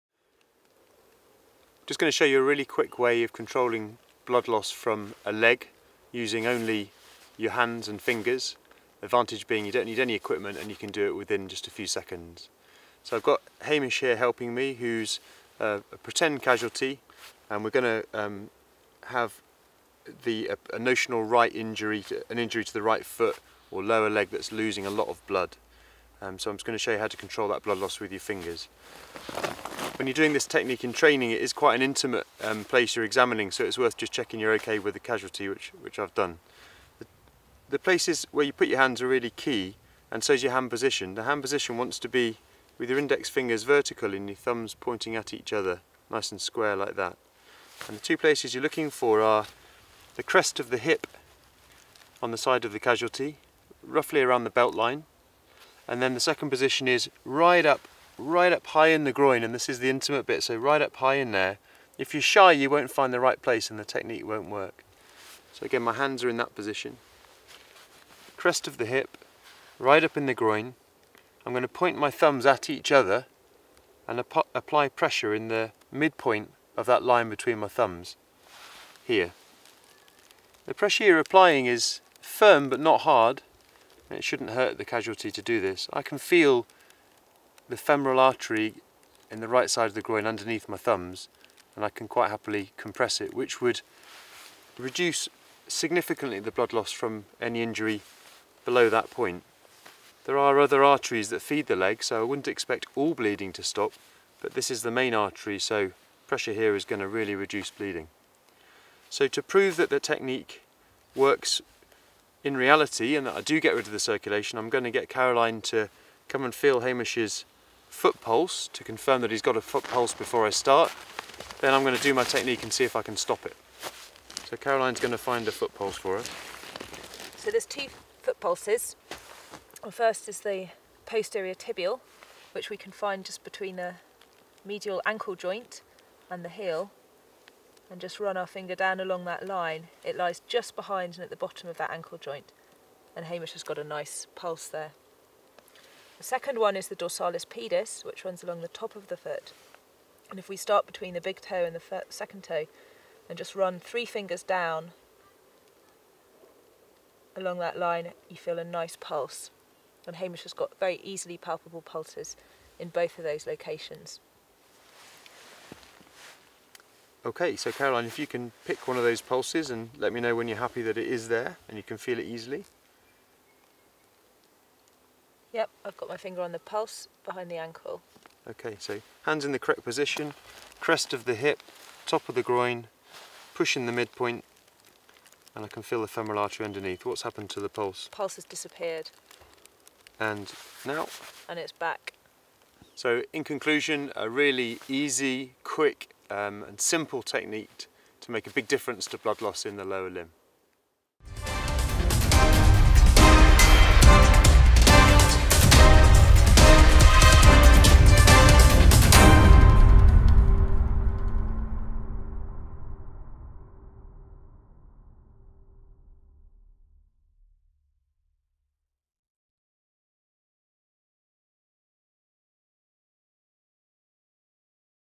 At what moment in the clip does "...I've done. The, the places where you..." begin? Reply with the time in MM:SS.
00:35.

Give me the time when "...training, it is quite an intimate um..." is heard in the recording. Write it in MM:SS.
00:30.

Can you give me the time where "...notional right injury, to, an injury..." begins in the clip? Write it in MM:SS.
00:20.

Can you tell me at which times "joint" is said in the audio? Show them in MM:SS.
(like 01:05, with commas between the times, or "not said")
02:15, 02:22.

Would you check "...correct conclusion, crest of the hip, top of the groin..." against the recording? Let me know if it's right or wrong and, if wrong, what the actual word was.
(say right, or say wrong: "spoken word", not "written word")
wrong: "position", not "conclusion".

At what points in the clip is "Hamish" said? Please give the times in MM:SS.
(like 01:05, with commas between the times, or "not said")
00:13, 01:56, 02:23, 02:40.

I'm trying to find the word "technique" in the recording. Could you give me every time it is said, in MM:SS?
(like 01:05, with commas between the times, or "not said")
00:30, 01:03, 01:50, 02:02, 03:17.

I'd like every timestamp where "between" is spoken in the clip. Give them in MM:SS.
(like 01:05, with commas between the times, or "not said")
01:17, 02:13, 02:30.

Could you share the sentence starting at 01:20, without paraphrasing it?
The pressure you're applying is firm but not hard, it shouldn't hurt the casualty to do this.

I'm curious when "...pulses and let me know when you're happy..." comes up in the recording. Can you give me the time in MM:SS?
02:49.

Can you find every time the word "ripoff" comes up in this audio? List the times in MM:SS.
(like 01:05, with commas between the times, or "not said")
not said.